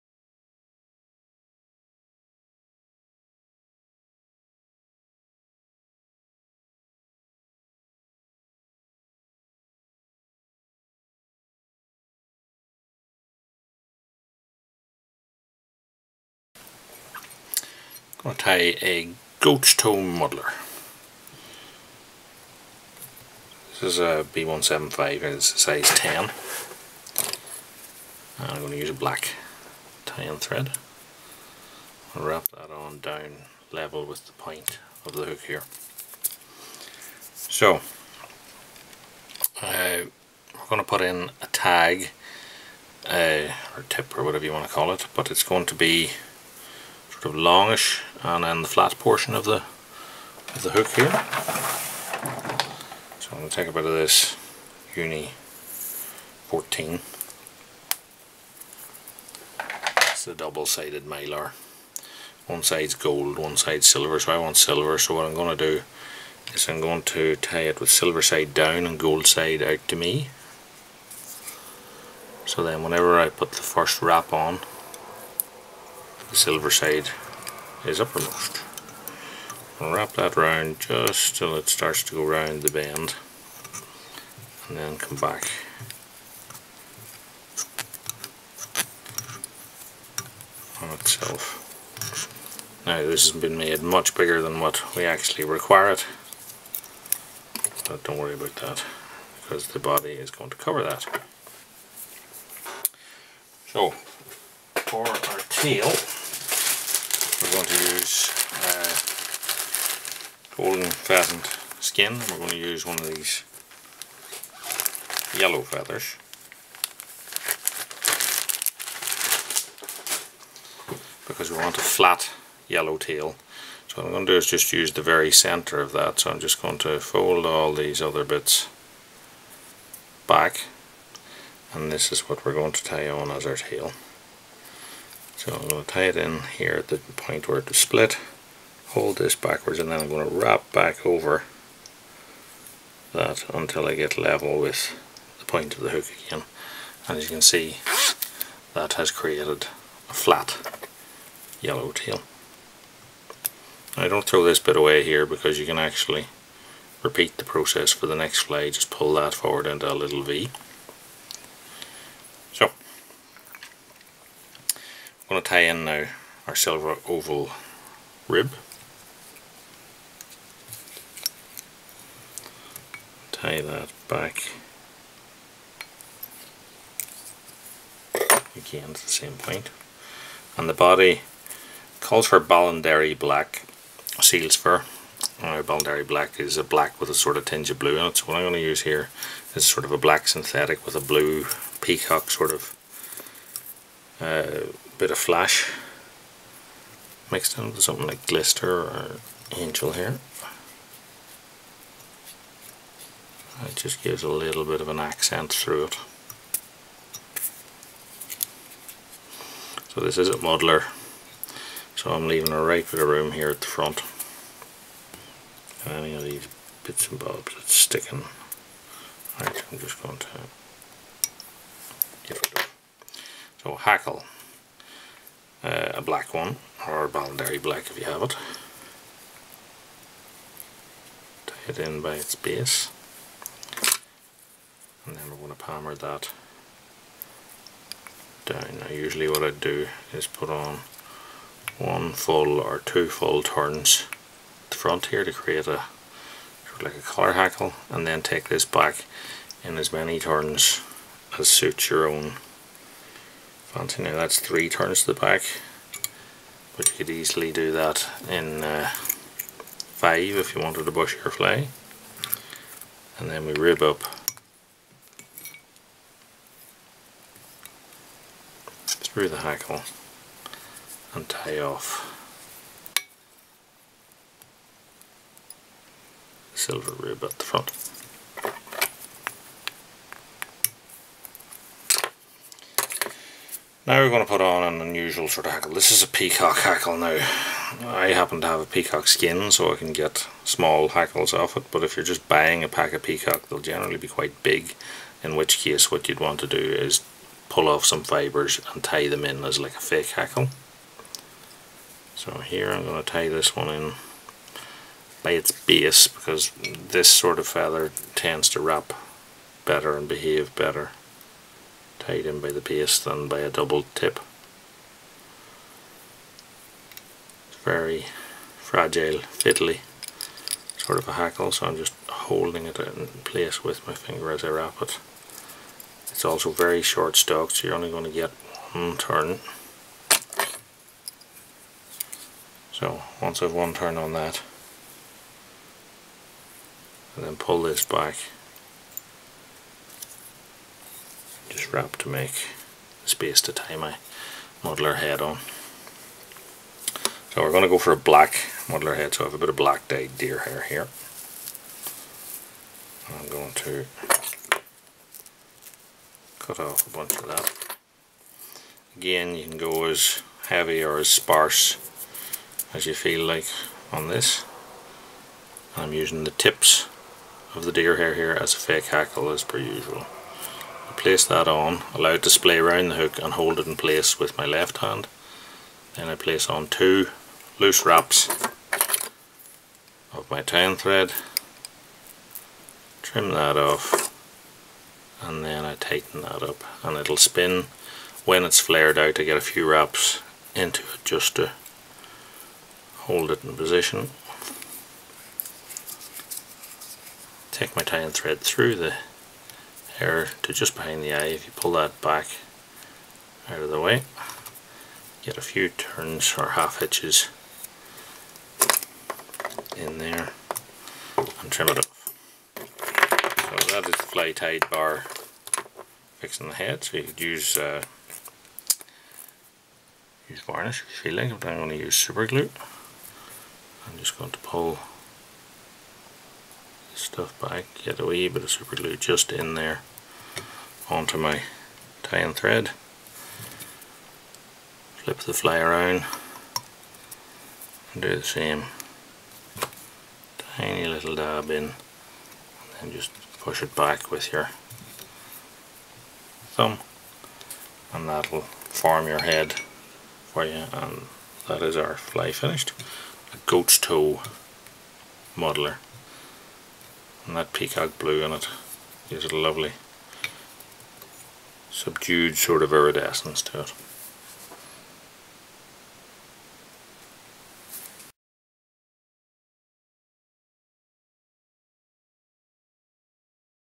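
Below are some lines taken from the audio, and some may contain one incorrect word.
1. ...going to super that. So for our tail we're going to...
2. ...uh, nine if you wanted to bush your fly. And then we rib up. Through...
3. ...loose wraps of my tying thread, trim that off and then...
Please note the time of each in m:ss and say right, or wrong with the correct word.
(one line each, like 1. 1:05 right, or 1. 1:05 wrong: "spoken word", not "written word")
1. 1:40 wrong: "cover", not "super"
2. 4:18 wrong: "five", not "nine"
3. 6:17 right.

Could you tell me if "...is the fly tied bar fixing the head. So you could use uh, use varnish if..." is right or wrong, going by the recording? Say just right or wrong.
right.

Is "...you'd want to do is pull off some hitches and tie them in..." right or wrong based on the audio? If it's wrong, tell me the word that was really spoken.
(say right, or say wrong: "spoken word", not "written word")
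wrong: "fibres", not "hitches".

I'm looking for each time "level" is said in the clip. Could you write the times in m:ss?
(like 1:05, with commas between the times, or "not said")
0:33, 2:24.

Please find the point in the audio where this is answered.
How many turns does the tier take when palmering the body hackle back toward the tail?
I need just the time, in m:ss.
4:14.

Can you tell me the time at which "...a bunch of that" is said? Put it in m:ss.
5:56.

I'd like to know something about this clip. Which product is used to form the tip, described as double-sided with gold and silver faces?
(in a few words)
Uni 14.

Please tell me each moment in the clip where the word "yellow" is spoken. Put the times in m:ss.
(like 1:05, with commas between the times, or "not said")
1:55, 2:02, 2:31.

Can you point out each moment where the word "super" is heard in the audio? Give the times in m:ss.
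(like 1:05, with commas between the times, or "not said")
7:01, 7:08.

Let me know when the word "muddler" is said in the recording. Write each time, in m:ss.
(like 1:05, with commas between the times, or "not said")
0:20, 3:30, 5:44, 5:48, 7:35.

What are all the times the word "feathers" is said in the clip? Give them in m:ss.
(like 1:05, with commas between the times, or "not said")
1:55, 5:07.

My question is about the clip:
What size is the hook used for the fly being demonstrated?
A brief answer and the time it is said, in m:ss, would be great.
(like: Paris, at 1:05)
10, at 0:25.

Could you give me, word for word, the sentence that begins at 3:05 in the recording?
Now Ballandary Black is a black with a sort of tinge of blue in it.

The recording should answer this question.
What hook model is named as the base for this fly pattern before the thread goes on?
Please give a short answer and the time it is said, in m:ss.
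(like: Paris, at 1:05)
B175, at 0:24.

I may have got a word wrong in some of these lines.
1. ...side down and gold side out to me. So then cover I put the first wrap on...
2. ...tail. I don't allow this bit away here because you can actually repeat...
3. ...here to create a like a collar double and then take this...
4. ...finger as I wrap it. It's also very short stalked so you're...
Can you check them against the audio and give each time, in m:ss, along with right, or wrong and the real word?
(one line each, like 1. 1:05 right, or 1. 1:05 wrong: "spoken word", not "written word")
1. 1:08 wrong: "whenever", not "cover"
2. 2:31 wrong: "throw", not "allow"
3. 4:05 wrong: "hackle", not "double"
4. 5:23 right.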